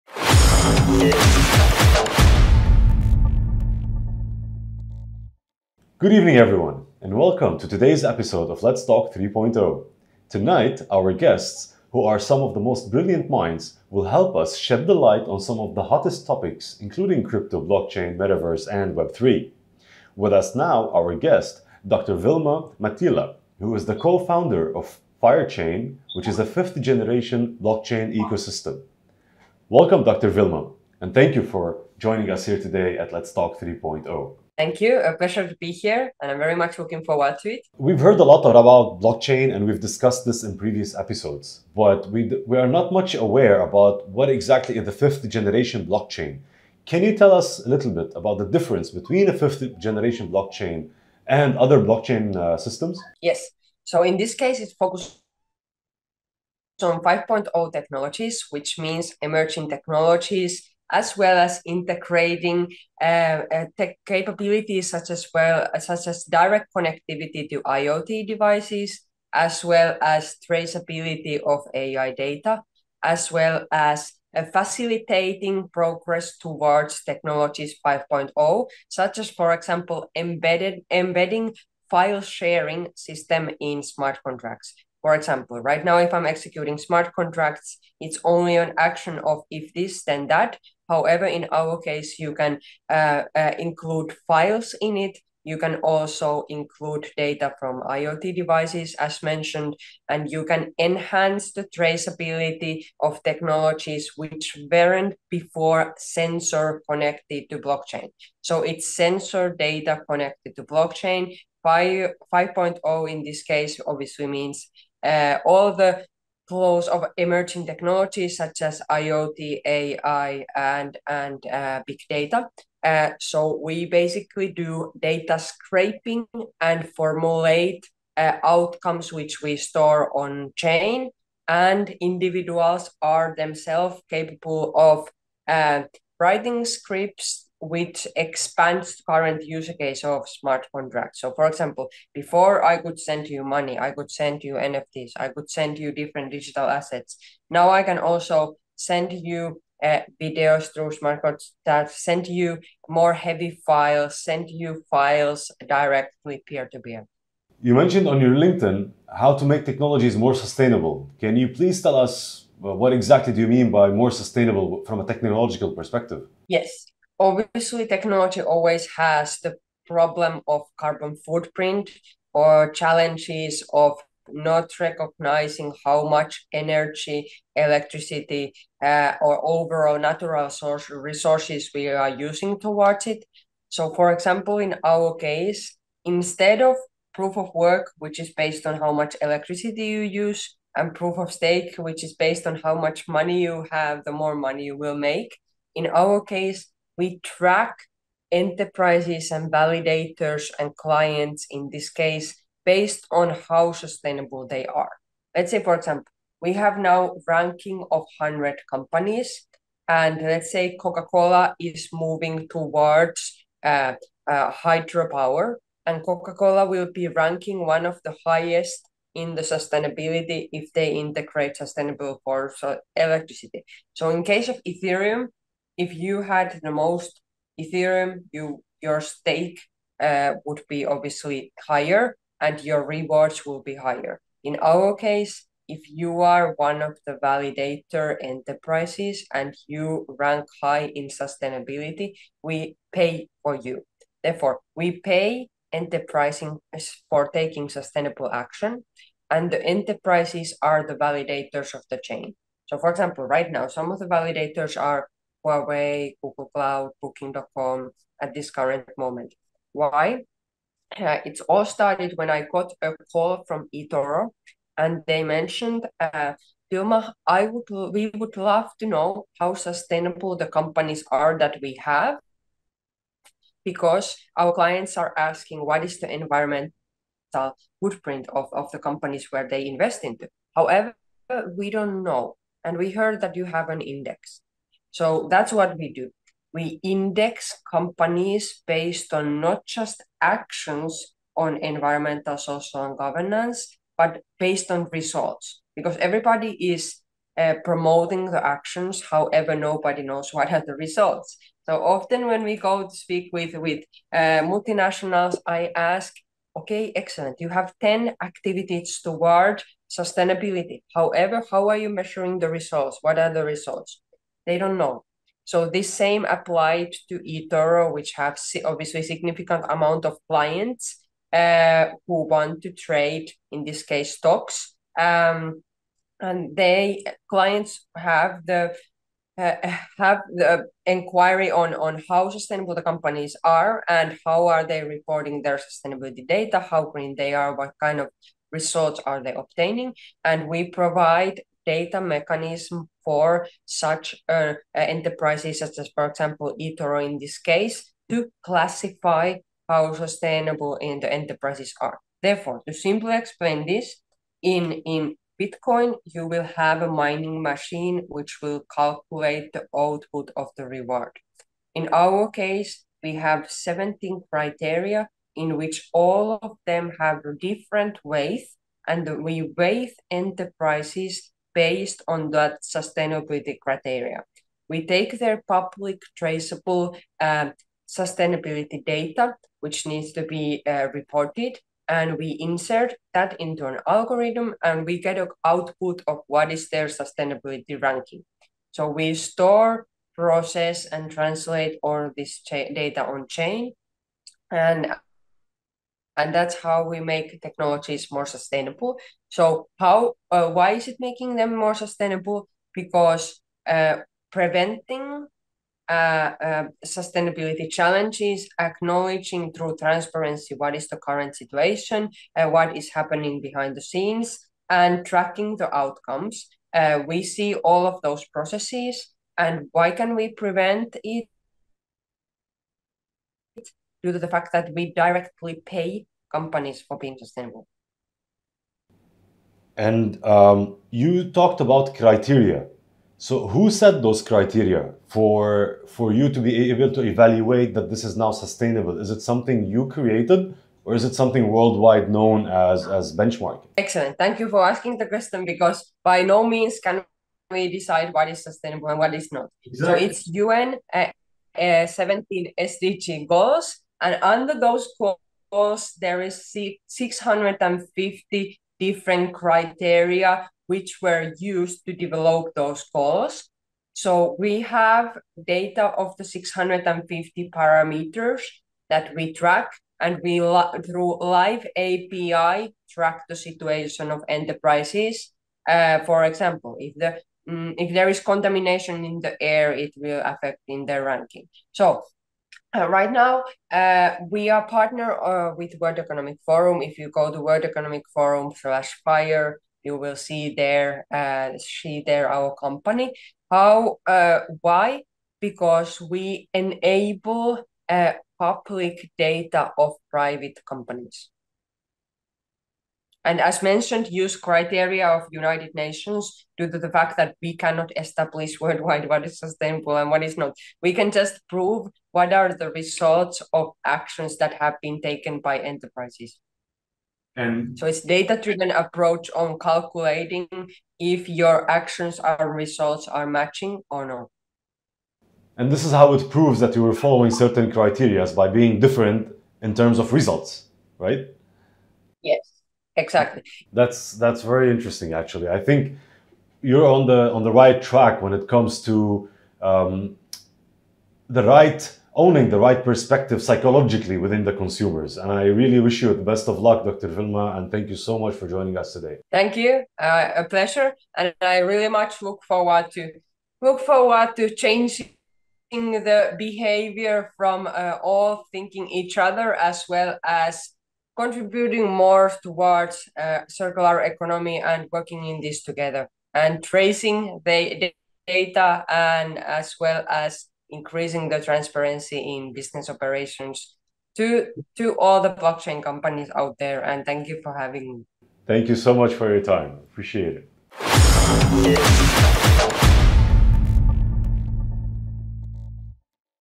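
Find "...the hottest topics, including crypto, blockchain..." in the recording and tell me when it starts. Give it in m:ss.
0:15.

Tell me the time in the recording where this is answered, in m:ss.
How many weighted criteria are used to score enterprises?
6:03.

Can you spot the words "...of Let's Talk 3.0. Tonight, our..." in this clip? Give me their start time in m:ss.
0:08.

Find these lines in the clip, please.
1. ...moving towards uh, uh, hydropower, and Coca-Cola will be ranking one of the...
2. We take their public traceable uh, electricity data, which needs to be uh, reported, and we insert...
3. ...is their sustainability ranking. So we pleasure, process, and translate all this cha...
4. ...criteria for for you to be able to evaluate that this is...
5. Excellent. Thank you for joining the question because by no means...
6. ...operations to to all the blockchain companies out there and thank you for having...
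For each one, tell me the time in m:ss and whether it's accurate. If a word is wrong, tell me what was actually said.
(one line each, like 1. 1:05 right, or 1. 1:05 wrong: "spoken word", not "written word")
1. 3:31 right
2. 6:14 wrong: "sustainability", not "electricity"
3. 6:26 wrong: "store", not "pleasure"
4. 7:14 right
5. 7:23 wrong: "asking", not "joining"
6. 9:32 right.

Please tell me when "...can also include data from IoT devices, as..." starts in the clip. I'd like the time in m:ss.
1:35.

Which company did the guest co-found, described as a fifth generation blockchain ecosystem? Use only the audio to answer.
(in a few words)
5ireChain.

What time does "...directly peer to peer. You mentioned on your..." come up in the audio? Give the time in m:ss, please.
2:35.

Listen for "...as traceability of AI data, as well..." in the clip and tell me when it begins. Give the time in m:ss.
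1:10.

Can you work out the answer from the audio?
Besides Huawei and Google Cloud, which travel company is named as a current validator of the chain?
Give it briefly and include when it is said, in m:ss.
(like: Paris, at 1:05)
Booking.com, at 4:17.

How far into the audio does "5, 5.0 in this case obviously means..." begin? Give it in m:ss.
1:51.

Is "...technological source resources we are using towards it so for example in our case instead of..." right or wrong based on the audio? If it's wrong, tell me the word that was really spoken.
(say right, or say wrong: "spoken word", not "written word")
wrong: "natural", not "technological".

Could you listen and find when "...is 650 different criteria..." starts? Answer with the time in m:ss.
7:36.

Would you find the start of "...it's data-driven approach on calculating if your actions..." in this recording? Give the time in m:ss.
8:37.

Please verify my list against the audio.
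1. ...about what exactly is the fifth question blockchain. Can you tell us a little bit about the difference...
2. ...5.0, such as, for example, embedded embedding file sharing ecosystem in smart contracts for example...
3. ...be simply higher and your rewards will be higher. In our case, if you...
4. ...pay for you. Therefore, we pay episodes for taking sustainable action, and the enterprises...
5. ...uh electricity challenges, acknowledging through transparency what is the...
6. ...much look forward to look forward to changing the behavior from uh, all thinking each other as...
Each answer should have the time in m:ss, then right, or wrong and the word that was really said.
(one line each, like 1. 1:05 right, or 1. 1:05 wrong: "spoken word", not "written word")
1. 0:43 wrong: "generation", not "question"
2. 1:17 wrong: "system", not "ecosystem"
3. 3:50 wrong: "obviously", not "simply"
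4. 4:02 wrong: "enterprises", not "episodes"
5. 6:46 wrong: "sustainability", not "electricity"
6. 9:11 right.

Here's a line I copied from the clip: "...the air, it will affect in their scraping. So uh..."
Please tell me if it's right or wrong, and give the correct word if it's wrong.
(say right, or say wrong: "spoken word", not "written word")
wrong: "ranking", not "scraping".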